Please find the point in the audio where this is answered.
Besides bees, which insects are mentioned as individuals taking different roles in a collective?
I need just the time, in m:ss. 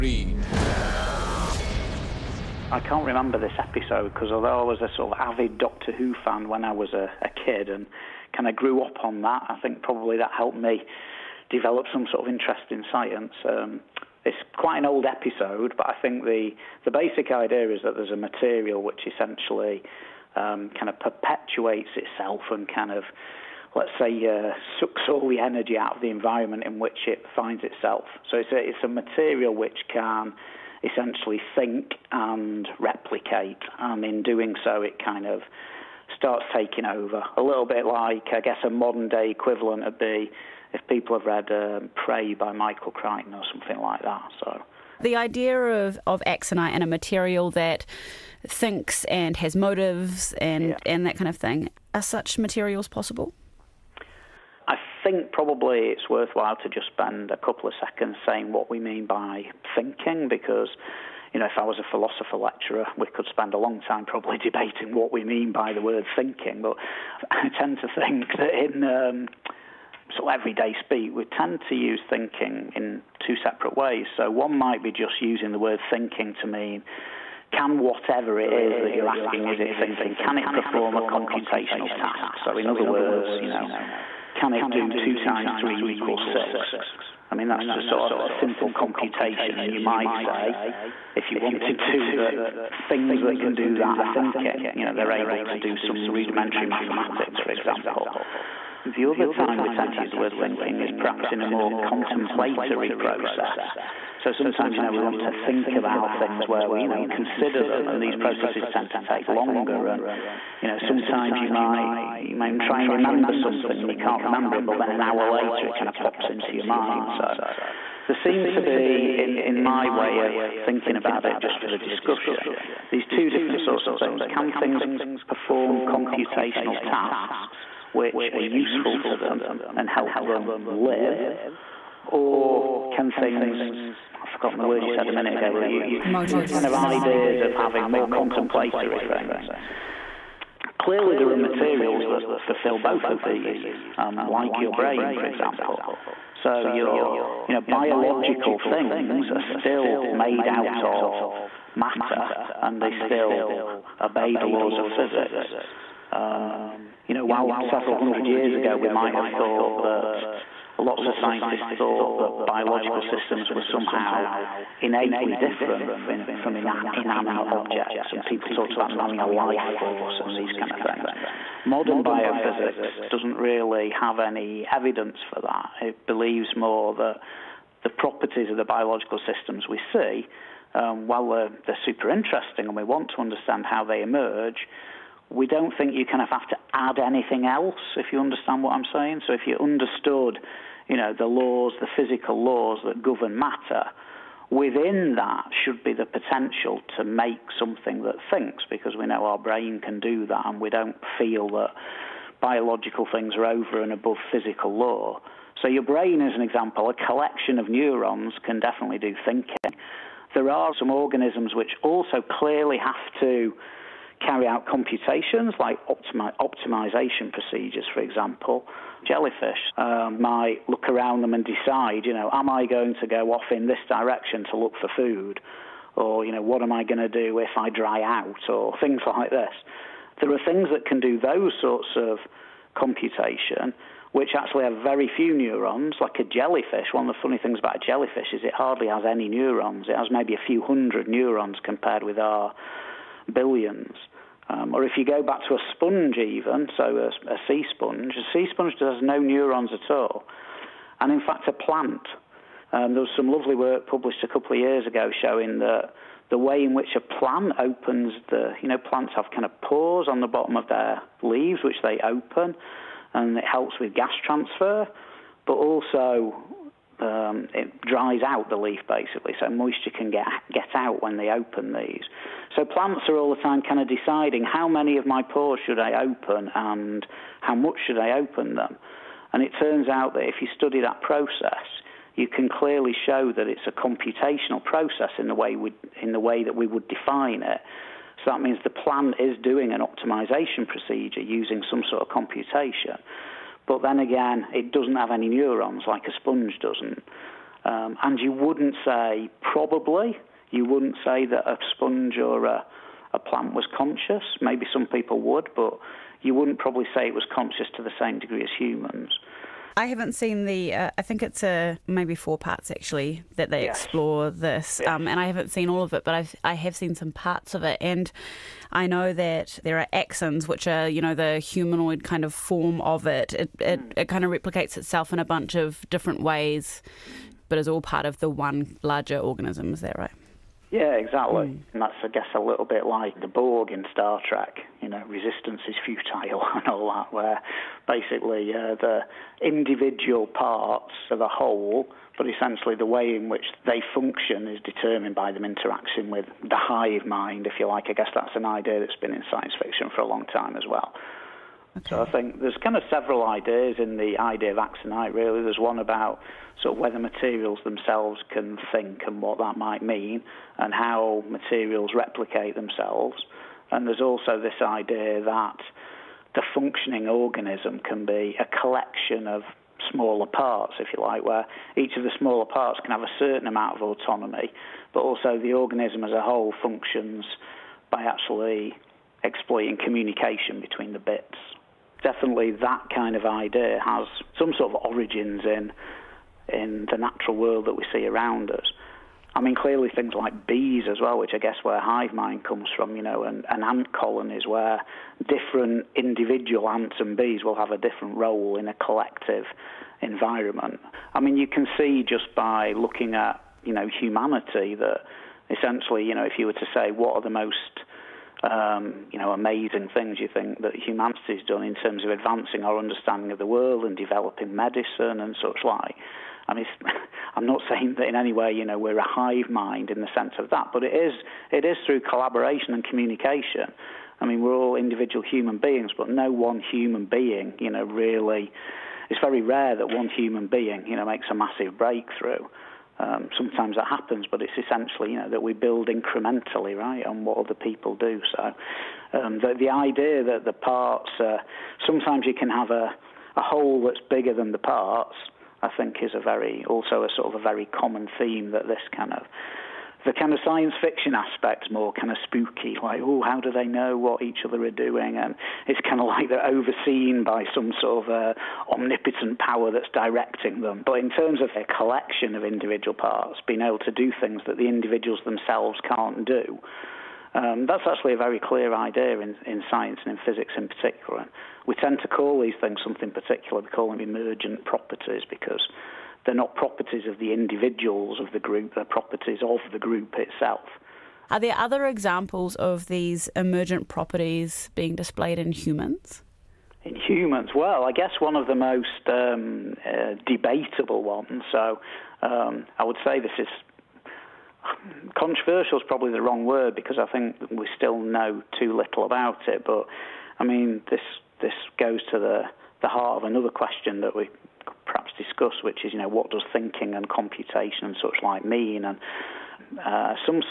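6:33.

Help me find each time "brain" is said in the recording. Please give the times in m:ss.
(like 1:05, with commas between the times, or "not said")
2:24, 3:19, 3:25.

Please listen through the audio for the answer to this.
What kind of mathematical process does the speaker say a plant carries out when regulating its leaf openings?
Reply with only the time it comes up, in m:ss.
4:49.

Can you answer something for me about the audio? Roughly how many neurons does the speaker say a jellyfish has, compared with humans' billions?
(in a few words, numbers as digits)
a few hundred.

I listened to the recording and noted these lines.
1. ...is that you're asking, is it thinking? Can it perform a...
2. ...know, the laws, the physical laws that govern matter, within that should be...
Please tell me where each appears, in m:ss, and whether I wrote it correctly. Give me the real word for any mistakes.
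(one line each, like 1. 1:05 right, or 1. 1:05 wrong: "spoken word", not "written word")
1. 1:18 right
2. 3:10 right.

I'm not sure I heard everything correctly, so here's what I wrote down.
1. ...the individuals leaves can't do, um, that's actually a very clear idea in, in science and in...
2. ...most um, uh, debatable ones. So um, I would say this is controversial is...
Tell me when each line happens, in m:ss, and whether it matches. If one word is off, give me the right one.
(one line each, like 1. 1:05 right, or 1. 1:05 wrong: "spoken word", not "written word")
1. 7:44 wrong: "themselves", not "leaves"
2. 8:08 right.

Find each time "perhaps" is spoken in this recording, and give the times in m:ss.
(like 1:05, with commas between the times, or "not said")
1:40, 8:24.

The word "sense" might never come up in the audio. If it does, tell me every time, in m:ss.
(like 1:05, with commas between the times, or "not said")
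7:00.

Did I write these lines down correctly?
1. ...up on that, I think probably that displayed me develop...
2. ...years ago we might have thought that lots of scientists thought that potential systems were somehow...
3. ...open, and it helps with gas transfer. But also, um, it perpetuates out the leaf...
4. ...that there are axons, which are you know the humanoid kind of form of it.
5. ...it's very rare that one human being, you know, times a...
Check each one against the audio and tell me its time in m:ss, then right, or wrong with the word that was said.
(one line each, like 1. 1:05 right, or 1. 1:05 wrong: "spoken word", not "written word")
1. 0:08 wrong: "helped", not "displayed"
2. 2:38 wrong: "biological", not "potential"
3. 4:22 wrong: "dries", not "perpetuates"
4. 5:19 right
5. 7:09 wrong: "makes", not "times".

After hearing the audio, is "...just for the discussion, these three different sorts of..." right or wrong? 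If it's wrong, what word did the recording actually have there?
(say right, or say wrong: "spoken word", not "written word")
wrong: "two", not "three".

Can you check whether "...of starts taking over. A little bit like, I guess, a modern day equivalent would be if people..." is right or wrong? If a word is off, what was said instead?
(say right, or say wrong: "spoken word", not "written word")
right.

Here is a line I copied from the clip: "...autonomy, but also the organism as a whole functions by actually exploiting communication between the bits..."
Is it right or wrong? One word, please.
right.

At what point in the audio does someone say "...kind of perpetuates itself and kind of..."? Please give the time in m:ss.
0:20.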